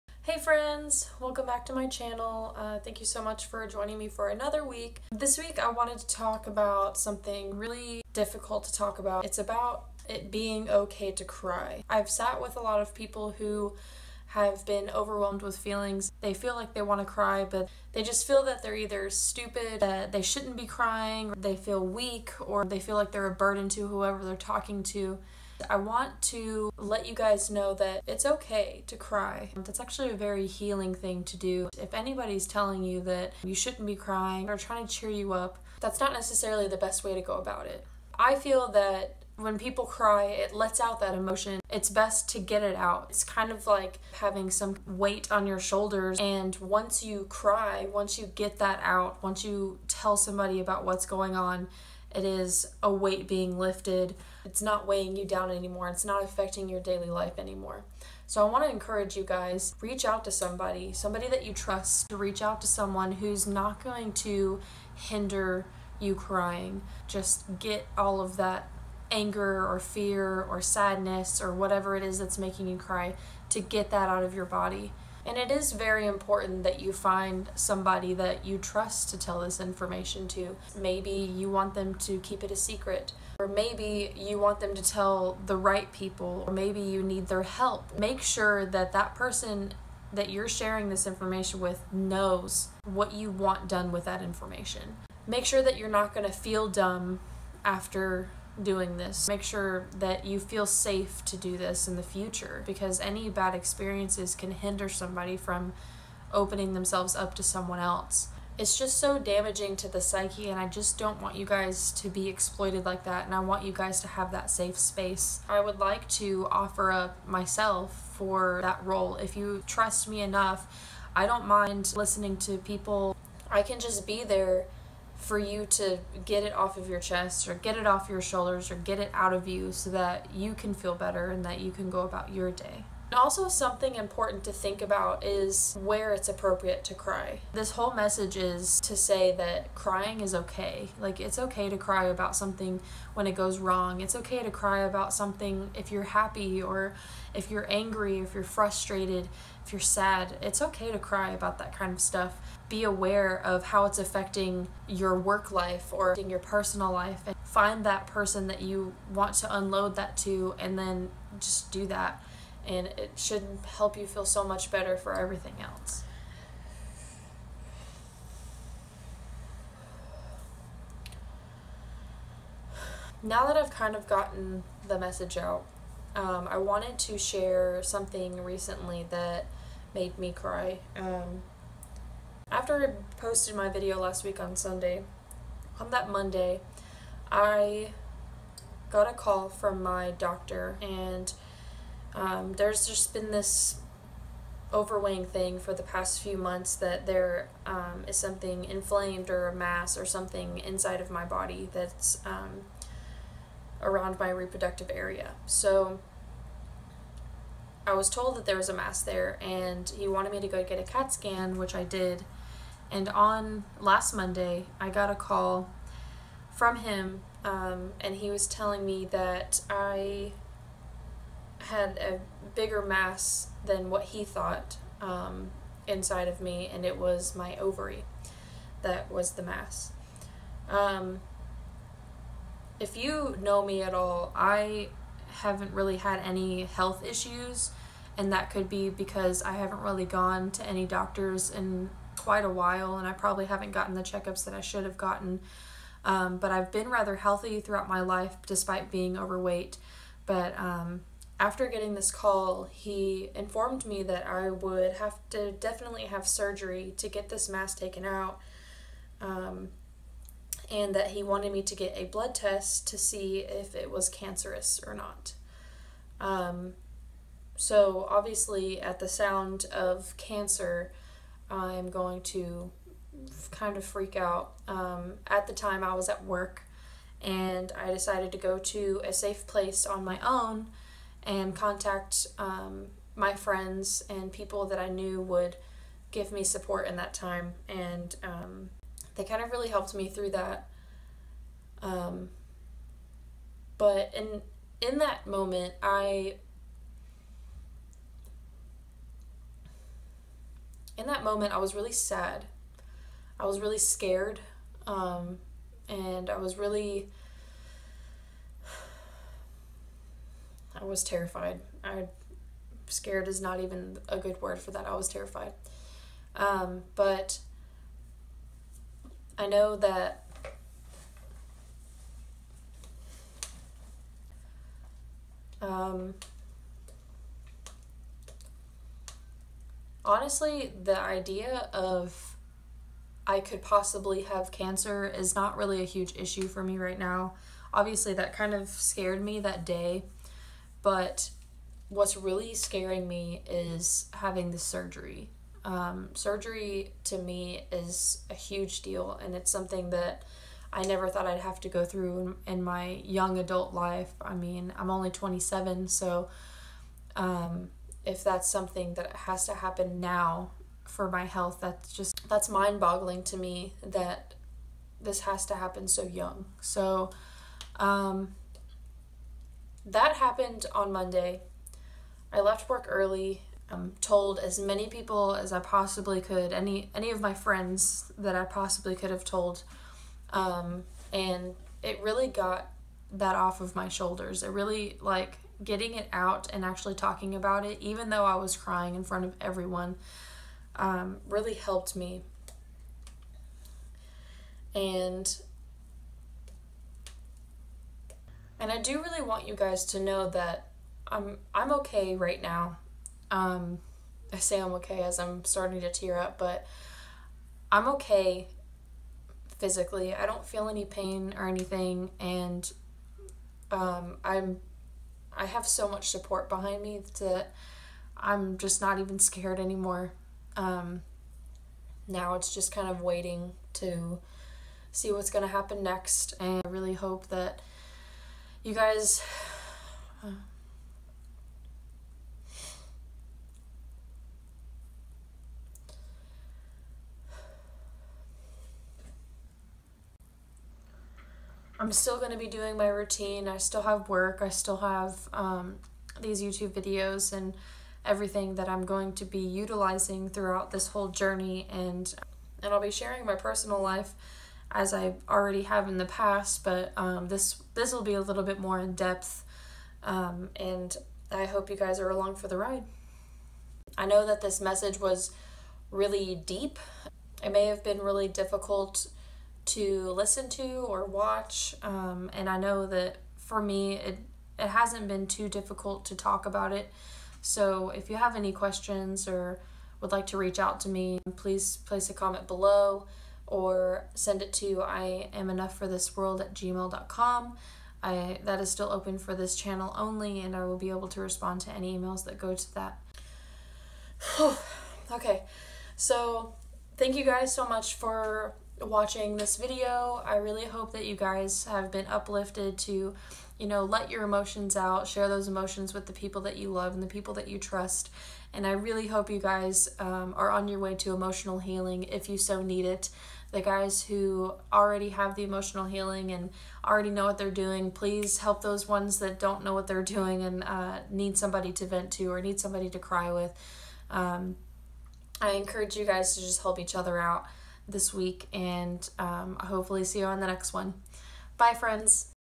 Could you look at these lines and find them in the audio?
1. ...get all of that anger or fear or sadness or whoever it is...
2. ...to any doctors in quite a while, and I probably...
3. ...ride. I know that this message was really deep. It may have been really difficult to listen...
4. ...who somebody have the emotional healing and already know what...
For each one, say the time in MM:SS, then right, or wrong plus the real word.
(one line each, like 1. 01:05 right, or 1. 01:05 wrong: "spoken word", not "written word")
1. 01:07 wrong: "whatever", not "whoever"
2. 04:00 right
3. 07:42 right
4. 08:34 wrong: "already", not "somebody".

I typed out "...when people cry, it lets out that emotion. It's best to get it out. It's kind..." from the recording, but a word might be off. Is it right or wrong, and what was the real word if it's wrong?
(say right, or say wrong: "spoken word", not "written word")
right.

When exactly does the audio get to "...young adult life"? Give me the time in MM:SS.
05:53.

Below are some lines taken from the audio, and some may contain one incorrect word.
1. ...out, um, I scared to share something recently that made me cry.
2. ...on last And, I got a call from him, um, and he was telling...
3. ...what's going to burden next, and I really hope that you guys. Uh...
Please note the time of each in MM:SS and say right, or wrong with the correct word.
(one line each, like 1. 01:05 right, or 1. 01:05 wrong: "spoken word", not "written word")
1. 02:55 wrong: "wanted", not "scared"
2. 03:33 wrong: "Monday", not "And"
3. 07:05 wrong: "happen", not "burden".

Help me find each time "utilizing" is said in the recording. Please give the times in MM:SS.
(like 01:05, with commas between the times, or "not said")
07:29.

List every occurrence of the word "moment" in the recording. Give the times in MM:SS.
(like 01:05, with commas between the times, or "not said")
04:55, 05:01.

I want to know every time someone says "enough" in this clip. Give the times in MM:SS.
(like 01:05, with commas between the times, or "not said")
02:00, 08:05.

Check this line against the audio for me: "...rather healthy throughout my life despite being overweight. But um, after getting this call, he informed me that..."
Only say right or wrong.
right.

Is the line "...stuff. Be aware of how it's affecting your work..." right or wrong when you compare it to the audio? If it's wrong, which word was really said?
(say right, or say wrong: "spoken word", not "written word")
right.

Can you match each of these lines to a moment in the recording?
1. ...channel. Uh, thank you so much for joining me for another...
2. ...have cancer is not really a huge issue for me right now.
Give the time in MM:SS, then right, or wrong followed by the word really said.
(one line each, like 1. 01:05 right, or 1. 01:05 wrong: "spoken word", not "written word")
1. 00:01 right
2. 05:34 right.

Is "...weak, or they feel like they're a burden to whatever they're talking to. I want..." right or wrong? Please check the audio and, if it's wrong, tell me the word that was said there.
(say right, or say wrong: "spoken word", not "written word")
wrong: "whoever", not "whatever".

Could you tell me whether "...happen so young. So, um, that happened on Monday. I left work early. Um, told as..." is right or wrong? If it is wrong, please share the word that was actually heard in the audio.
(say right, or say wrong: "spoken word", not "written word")
right.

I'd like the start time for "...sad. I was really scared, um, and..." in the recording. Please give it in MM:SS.
05:01.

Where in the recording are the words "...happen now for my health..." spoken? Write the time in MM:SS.
05:59.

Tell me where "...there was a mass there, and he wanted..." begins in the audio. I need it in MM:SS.
03:28.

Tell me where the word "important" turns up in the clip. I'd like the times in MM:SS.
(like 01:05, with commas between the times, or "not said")
01:16, 02:13.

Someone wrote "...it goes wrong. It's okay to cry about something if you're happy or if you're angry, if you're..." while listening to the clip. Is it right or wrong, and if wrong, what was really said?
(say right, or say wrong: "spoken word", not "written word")
right.